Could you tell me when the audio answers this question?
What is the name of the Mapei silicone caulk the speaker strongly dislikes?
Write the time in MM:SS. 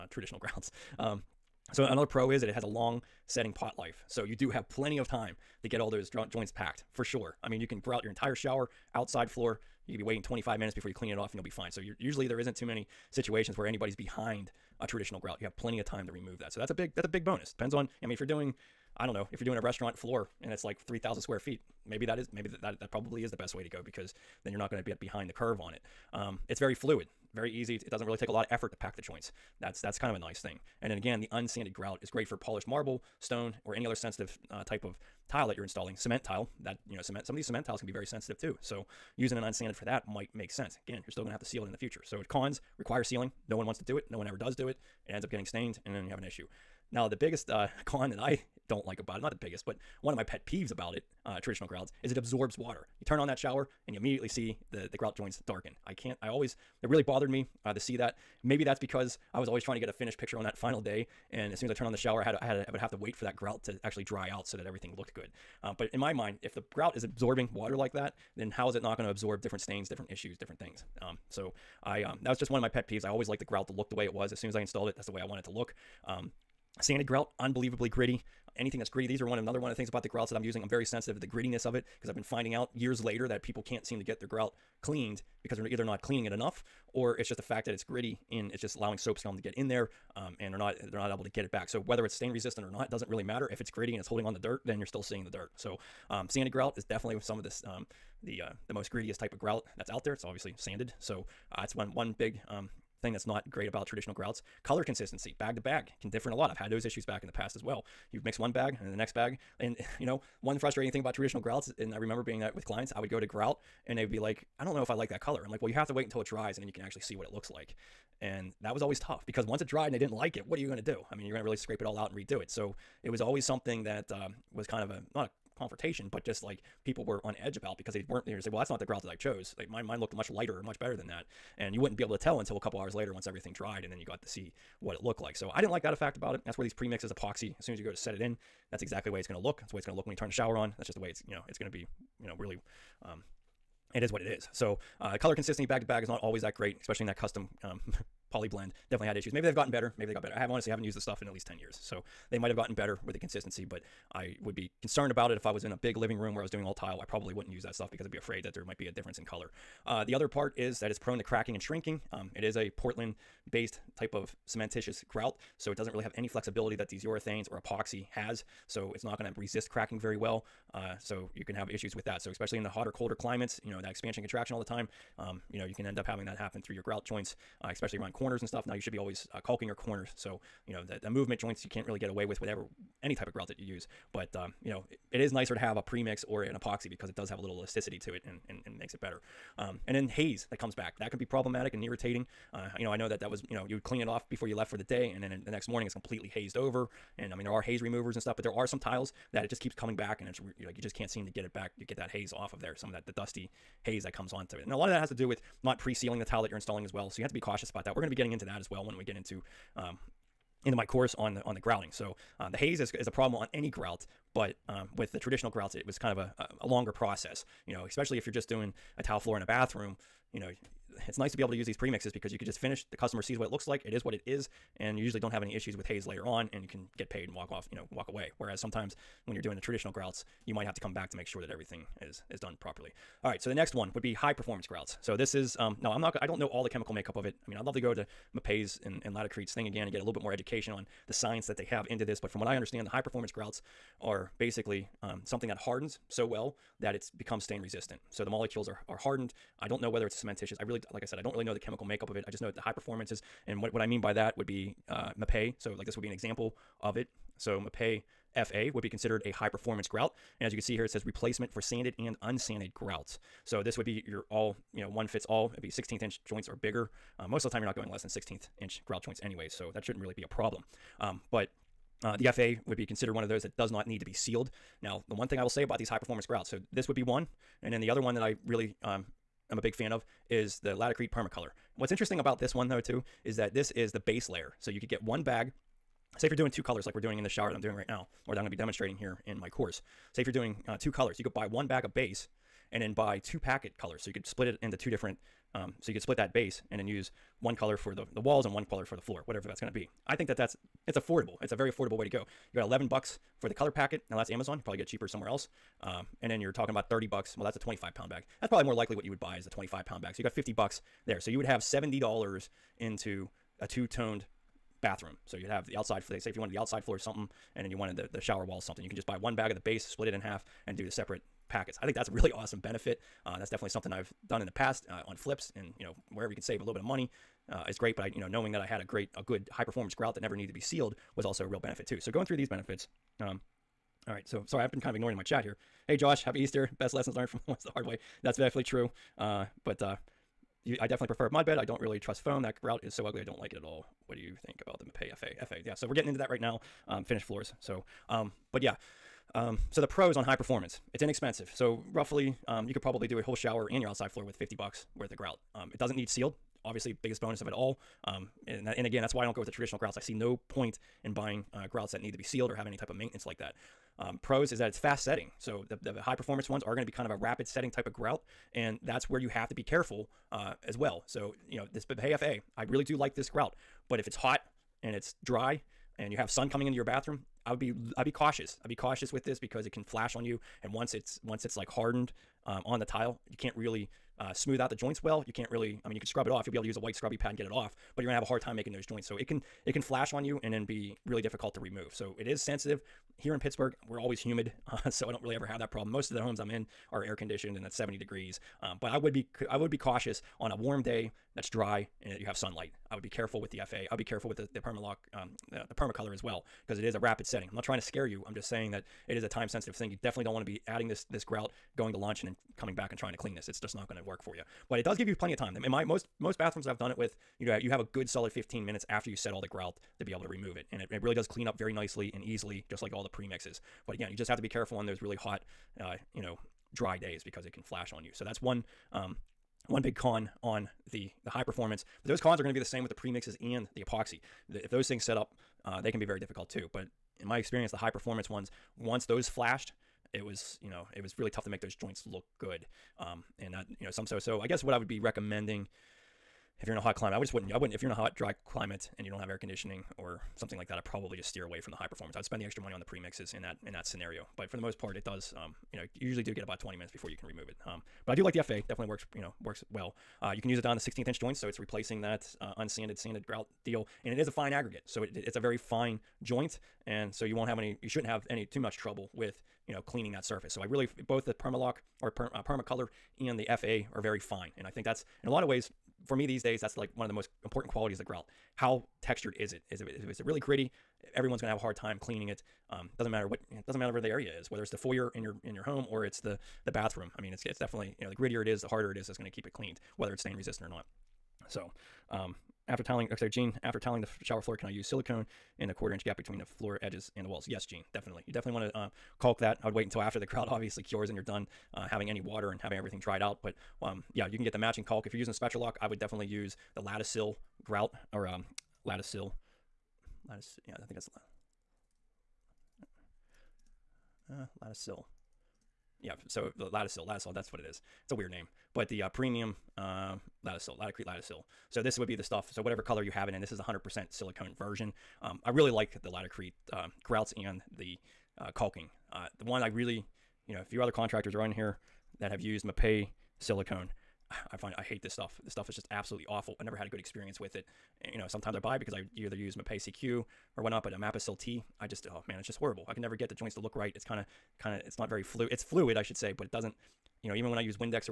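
09:00.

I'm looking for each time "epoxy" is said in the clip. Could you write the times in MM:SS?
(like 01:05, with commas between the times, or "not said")
02:17, 02:47, 03:06, 07:13.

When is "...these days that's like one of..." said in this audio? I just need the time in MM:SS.
07:56.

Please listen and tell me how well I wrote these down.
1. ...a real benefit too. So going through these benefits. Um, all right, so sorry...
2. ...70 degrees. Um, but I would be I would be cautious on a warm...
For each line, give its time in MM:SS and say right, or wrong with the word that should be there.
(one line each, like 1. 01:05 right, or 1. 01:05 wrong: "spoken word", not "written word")
1. 05:31 right
2. 06:37 right.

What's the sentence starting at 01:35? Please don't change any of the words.
So um, sanded grout is definitely some of this um, the uh, the most grittiest type of grout that's out there.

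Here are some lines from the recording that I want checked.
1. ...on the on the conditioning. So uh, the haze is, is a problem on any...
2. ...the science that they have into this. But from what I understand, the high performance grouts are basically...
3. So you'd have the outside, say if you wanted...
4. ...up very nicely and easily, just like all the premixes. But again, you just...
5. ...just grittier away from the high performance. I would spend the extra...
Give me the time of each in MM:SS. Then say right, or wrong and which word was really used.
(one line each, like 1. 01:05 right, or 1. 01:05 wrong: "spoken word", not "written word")
1. 03:31 wrong: "grouting", not "conditioning"
2. 04:01 right
3. 05:15 right
4. 07:01 right
5. 07:31 wrong: "steer", not "grittier".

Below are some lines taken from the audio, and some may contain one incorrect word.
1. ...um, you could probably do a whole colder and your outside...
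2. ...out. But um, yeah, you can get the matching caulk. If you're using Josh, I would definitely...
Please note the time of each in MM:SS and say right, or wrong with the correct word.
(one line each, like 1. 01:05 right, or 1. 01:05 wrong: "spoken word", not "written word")
1. 05:52 wrong: "shower", not "colder"
2. 08:23 wrong: "Spectralock", not "Josh".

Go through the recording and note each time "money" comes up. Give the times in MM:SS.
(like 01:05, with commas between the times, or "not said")
05:26, 07:32.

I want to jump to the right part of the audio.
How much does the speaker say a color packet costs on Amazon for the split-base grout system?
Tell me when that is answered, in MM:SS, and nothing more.
05:02.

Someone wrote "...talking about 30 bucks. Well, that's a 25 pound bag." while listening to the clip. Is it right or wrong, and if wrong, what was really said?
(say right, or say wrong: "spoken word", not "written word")
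right.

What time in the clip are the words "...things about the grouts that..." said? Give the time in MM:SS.
01:19.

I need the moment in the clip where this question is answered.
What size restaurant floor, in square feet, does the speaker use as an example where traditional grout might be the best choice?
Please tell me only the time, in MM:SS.
00:20.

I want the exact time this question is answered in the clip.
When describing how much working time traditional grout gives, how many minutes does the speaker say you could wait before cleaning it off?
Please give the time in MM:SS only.
00:10.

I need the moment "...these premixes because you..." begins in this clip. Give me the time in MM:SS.
03:41.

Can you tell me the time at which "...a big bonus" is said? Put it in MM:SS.
00:17.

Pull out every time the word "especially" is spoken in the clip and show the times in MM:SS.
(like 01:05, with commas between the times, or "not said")
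02:26, 02:52, 02:57, 03:37.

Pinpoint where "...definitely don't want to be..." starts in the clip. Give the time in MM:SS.
06:50.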